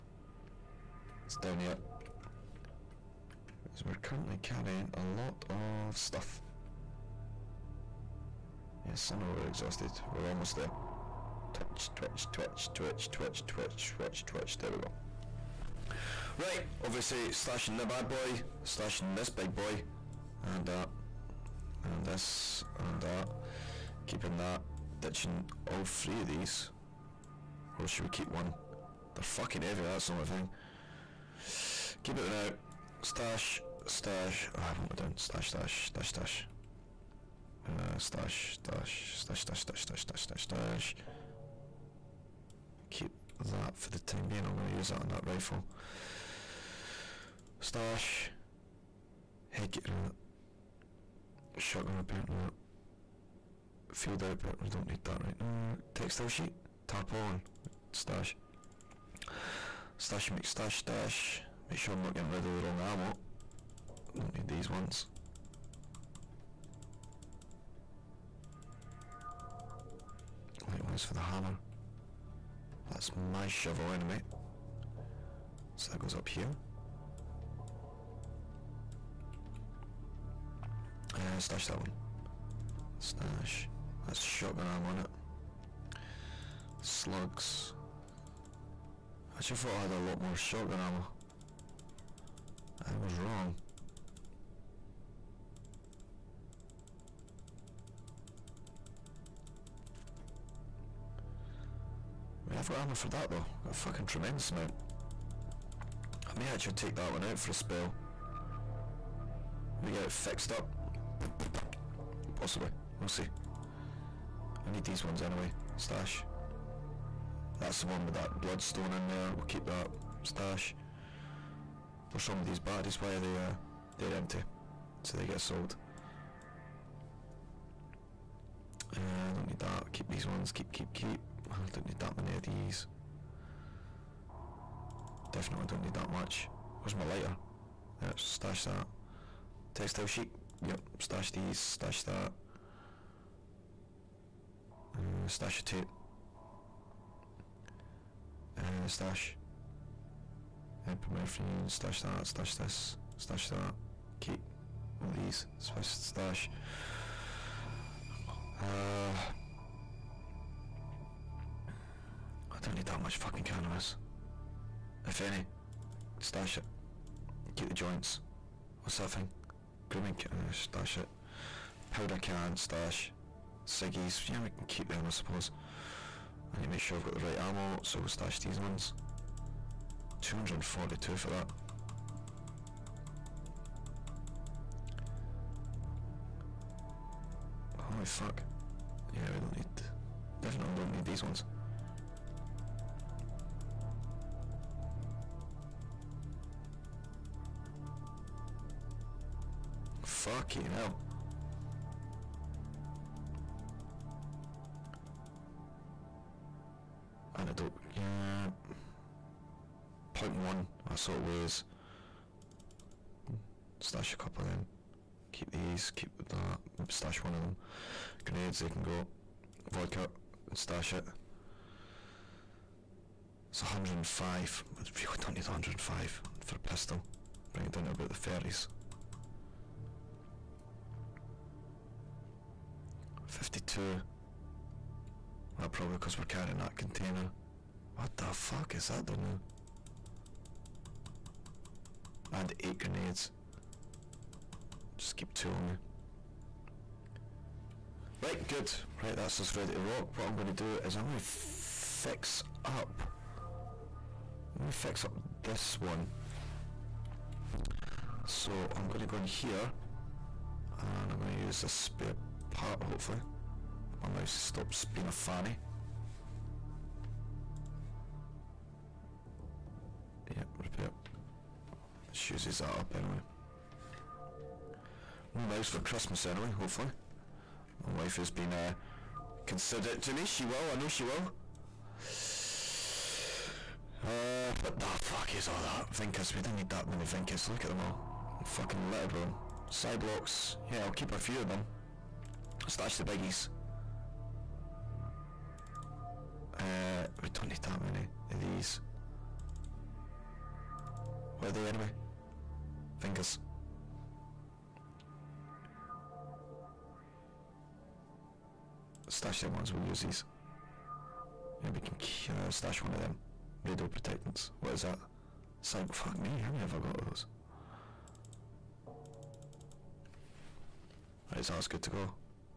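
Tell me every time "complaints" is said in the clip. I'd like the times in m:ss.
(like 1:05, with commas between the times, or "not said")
not said.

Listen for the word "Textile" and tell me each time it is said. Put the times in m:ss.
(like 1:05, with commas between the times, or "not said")
0:55, 2:19.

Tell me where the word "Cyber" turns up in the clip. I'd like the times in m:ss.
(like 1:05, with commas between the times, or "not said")
5:15.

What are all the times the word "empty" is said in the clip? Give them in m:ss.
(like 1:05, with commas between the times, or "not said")
2:04.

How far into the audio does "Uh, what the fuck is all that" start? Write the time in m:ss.
4:44.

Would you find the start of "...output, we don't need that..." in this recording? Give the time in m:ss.
0:54.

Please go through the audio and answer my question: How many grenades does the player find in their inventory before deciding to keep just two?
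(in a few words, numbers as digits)
8.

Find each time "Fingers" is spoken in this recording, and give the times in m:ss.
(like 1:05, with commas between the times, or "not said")
5:02.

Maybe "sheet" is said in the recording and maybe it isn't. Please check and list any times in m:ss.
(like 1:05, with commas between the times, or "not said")
0:56, 2:20.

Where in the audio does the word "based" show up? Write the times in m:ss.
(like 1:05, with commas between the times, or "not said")
not said.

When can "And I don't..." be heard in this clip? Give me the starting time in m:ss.
3:27.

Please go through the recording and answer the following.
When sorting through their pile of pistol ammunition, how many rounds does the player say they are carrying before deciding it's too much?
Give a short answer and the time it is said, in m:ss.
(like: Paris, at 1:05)
105, at 3:43.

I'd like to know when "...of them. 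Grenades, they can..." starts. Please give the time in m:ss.
3:37.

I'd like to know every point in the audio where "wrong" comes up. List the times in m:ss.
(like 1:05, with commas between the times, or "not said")
1:02, 1:33, 2:02.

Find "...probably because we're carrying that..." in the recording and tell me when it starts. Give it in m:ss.
3:55.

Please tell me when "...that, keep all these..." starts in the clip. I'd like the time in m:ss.
2:33.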